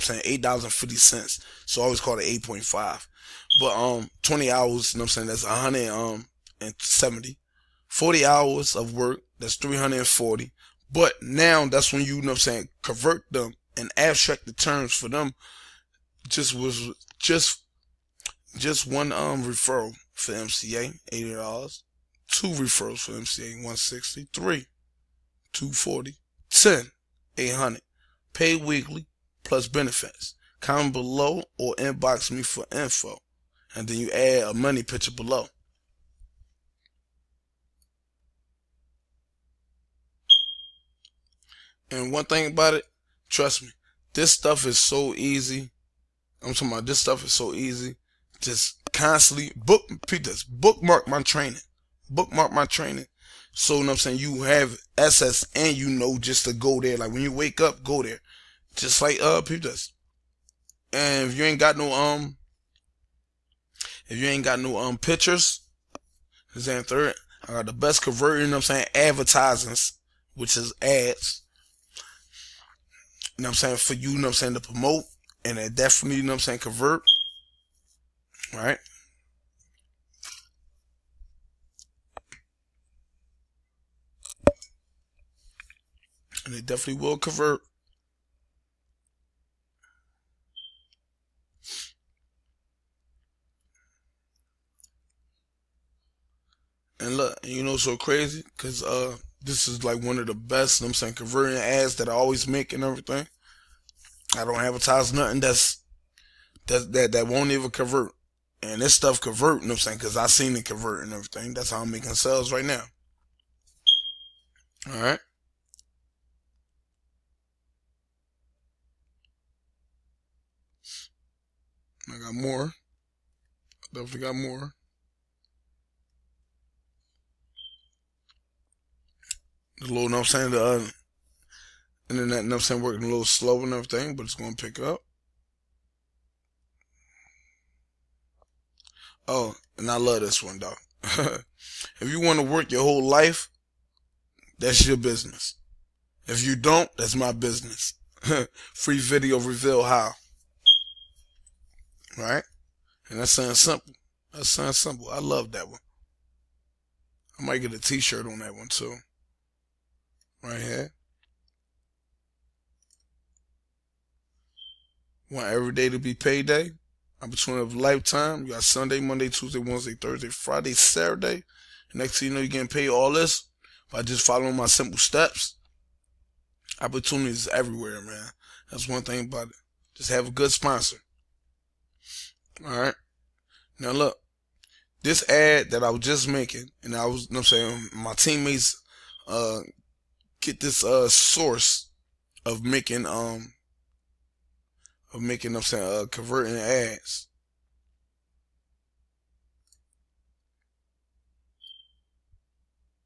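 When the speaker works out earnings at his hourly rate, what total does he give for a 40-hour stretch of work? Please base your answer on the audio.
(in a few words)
$340.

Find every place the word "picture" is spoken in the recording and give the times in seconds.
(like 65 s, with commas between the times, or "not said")
34 s, 64 s.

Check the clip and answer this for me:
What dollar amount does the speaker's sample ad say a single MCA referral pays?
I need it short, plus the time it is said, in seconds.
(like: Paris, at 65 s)
$80, at 21 s.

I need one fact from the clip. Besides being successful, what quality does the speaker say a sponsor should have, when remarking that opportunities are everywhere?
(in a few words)
Good.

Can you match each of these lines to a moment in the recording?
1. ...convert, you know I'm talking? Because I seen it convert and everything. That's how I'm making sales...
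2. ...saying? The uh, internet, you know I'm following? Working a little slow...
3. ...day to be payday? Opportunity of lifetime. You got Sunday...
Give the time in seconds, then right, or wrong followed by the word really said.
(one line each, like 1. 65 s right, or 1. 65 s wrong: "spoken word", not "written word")
1. 109 s wrong: "saying", not "talking"
2. 130 s wrong: "saying", not "following"
3. 165 s right.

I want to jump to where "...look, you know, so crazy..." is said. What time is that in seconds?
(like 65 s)
97 s.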